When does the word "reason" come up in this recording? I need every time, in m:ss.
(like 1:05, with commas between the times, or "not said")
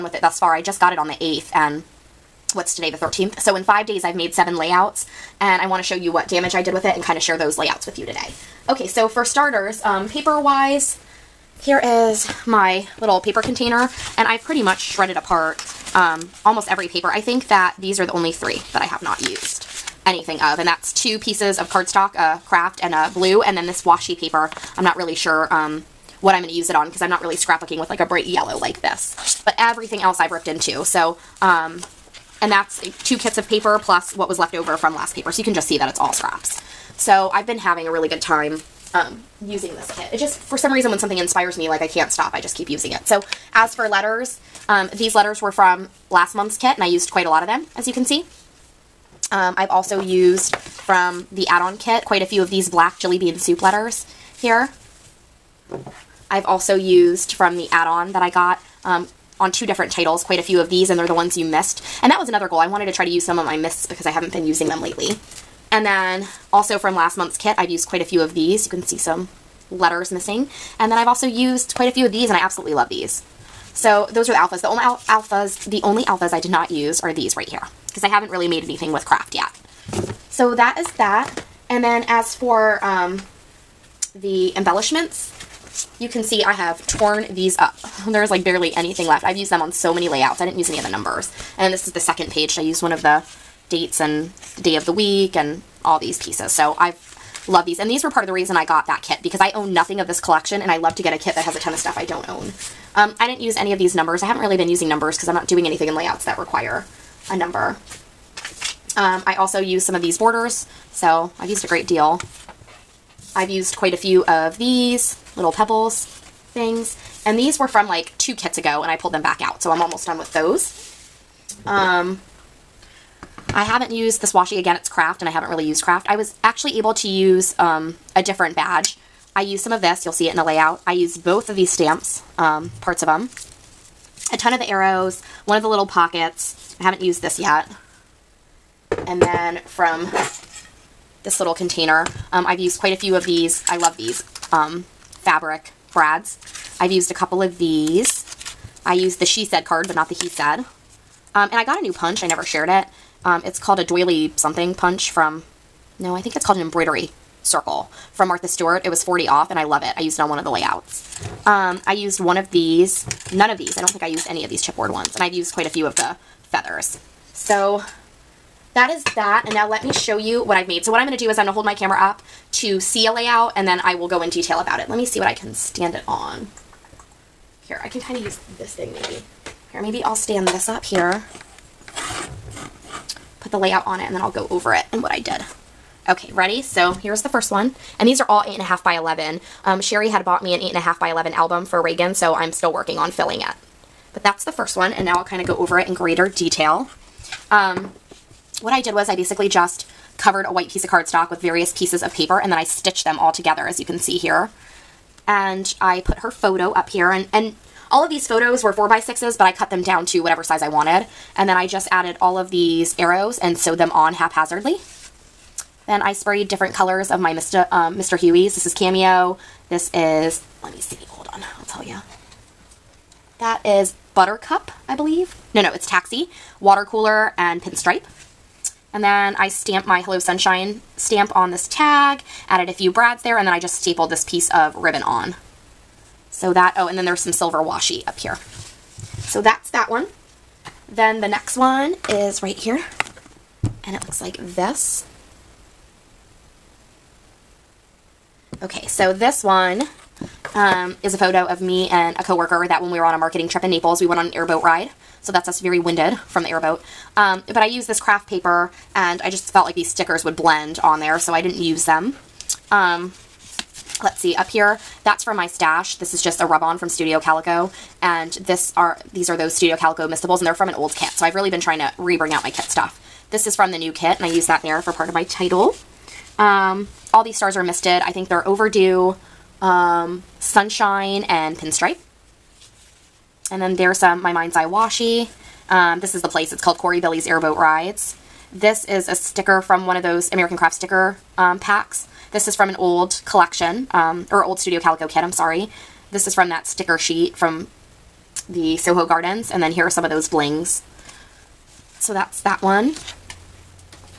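0:40, 1:38.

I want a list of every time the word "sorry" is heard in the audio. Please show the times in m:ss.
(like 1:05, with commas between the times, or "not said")
4:55.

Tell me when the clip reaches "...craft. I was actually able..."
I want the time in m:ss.
2:05.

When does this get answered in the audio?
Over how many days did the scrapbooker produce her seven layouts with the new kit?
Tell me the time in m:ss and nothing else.
0:03.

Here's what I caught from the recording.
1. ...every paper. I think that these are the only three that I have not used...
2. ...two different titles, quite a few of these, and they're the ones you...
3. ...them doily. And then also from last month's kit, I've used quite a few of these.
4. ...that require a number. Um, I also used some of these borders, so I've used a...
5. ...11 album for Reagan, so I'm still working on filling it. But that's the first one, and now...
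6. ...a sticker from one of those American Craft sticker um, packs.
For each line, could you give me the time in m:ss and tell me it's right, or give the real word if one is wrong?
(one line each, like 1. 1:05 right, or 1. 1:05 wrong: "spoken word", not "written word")
1. 0:16 right
2. 0:59 right
3. 1:04 wrong: "lately", not "doily"
4. 1:46 right
5. 3:11 right
6. 4:49 right.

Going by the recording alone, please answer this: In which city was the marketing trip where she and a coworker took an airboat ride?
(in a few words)
Naples.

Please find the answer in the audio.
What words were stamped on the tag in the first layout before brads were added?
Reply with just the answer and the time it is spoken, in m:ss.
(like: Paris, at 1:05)
Hello Sunshine, at 3:50.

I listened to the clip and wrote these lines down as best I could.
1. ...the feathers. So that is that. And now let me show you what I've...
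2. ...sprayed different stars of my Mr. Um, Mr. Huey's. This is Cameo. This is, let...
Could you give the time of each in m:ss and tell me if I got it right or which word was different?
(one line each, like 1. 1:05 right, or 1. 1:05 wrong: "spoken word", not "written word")
1. 2:45 right
2. 3:36 wrong: "colors", not "stars".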